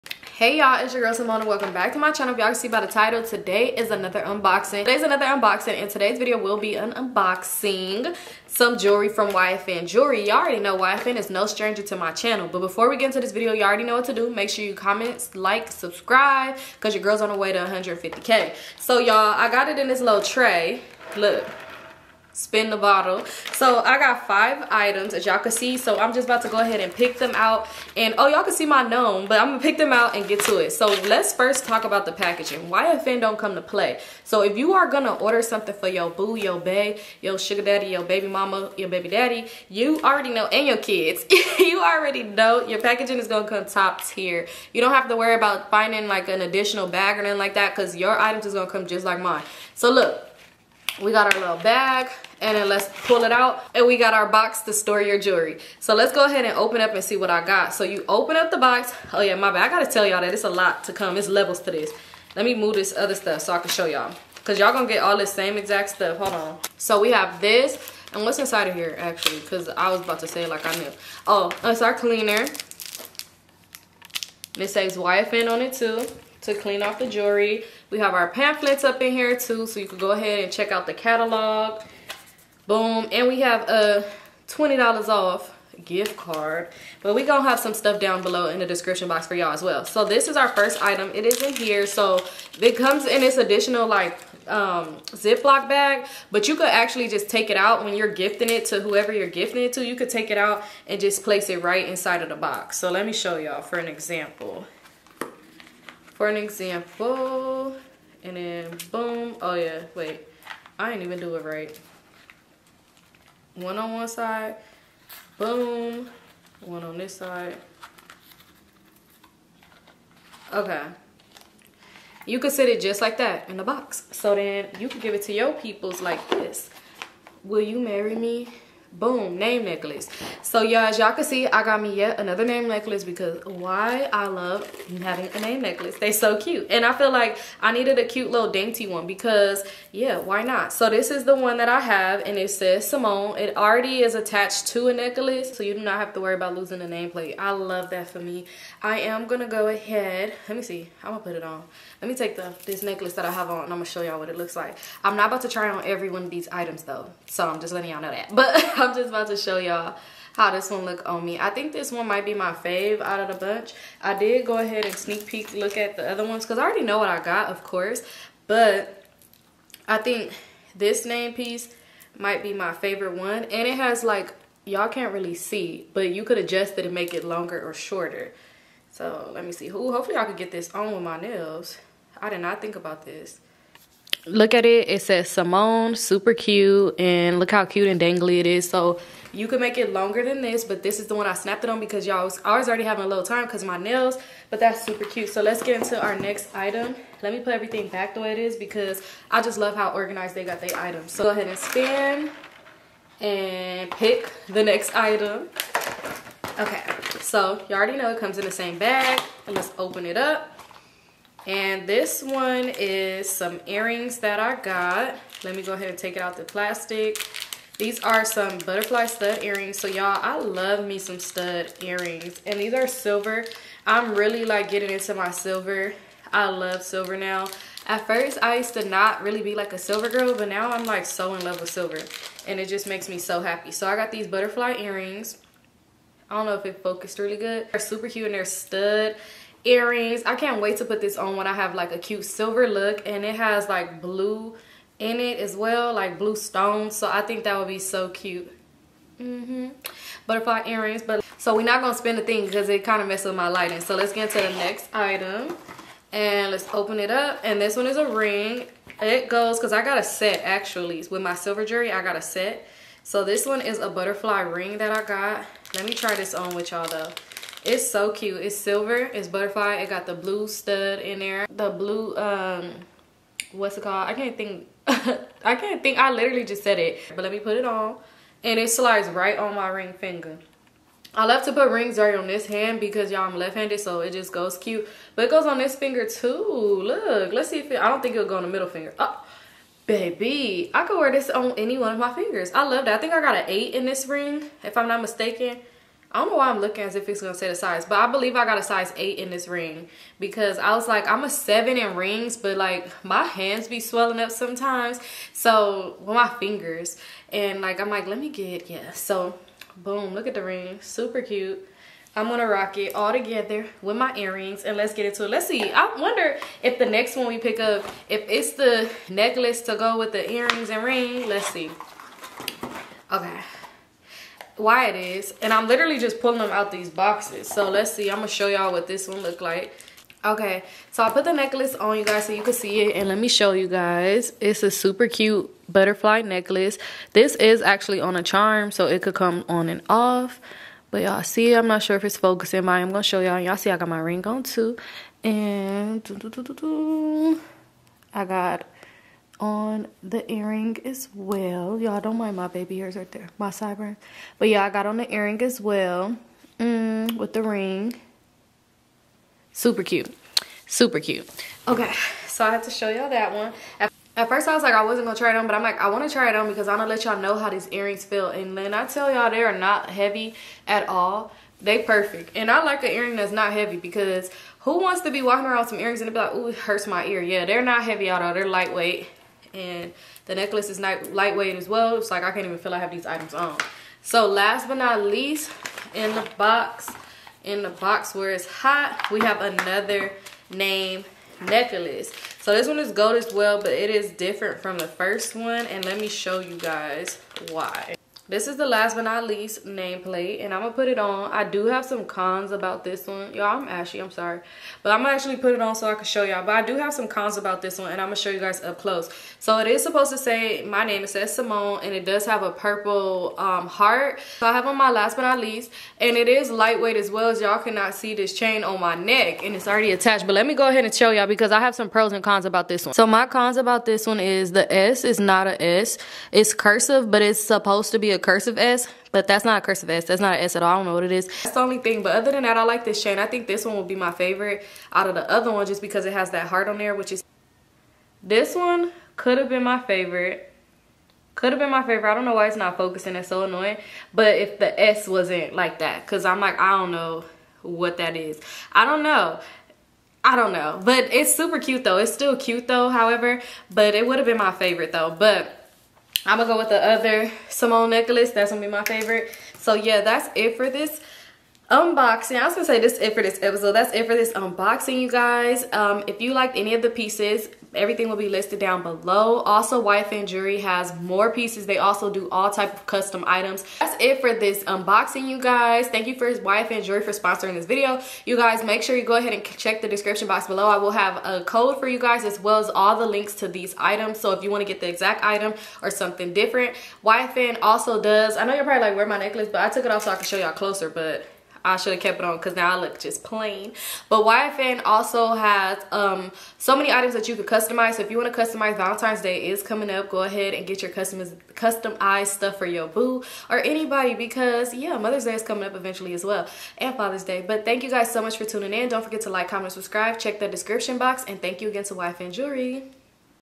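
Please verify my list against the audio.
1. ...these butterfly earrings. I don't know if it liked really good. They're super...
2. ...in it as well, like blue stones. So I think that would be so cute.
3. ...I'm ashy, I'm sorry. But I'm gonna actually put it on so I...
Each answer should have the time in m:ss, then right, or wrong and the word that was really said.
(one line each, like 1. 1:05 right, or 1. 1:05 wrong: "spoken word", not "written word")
1. 3:54 wrong: "focused", not "liked"
2. 4:04 right
3. 6:43 right.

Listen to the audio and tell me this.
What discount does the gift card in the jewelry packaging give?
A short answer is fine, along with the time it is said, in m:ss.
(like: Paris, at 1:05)
$20 off, at 1:24.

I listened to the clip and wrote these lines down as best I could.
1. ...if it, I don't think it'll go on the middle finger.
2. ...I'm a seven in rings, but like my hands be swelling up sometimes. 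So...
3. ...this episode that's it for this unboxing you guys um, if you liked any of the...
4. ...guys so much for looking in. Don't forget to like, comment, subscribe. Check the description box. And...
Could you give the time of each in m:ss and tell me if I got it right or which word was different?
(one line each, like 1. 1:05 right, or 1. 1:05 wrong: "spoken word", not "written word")
1. 4:47 right
2. 5:01 right
3. 7:43 right
4. 8:27 wrong: "tuning", not "looking".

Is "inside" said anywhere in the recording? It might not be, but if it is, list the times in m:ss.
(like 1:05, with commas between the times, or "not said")
1:08, 1:41.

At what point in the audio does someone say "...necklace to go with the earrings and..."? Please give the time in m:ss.
5:19.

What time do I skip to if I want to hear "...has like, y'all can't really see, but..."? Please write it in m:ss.
2:53.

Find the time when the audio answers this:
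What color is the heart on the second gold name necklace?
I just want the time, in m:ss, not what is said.
6:52.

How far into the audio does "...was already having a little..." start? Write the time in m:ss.
3:12.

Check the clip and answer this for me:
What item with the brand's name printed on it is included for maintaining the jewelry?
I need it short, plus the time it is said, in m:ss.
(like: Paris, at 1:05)
cleaner, at 1:11.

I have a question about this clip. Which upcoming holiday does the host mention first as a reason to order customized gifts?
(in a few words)
Valentine's Day.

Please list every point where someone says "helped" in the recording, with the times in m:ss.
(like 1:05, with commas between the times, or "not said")
not said.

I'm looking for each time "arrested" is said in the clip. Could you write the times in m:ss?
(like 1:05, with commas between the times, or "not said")
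not said.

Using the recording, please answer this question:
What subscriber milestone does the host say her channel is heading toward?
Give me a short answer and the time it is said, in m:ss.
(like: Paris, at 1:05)
150k, at 0:17.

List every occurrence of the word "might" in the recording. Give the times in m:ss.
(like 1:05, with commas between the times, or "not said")
2:42, 2:52.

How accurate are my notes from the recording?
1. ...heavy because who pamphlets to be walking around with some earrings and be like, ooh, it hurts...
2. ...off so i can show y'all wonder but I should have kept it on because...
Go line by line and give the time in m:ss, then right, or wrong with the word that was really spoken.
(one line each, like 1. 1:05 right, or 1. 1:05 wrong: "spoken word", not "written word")
1. 6:13 wrong: "wants", not "pamphlets"
2. 8:09 wrong: "closer", not "wonder".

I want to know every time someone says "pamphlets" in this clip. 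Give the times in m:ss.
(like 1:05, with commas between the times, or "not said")
1:18.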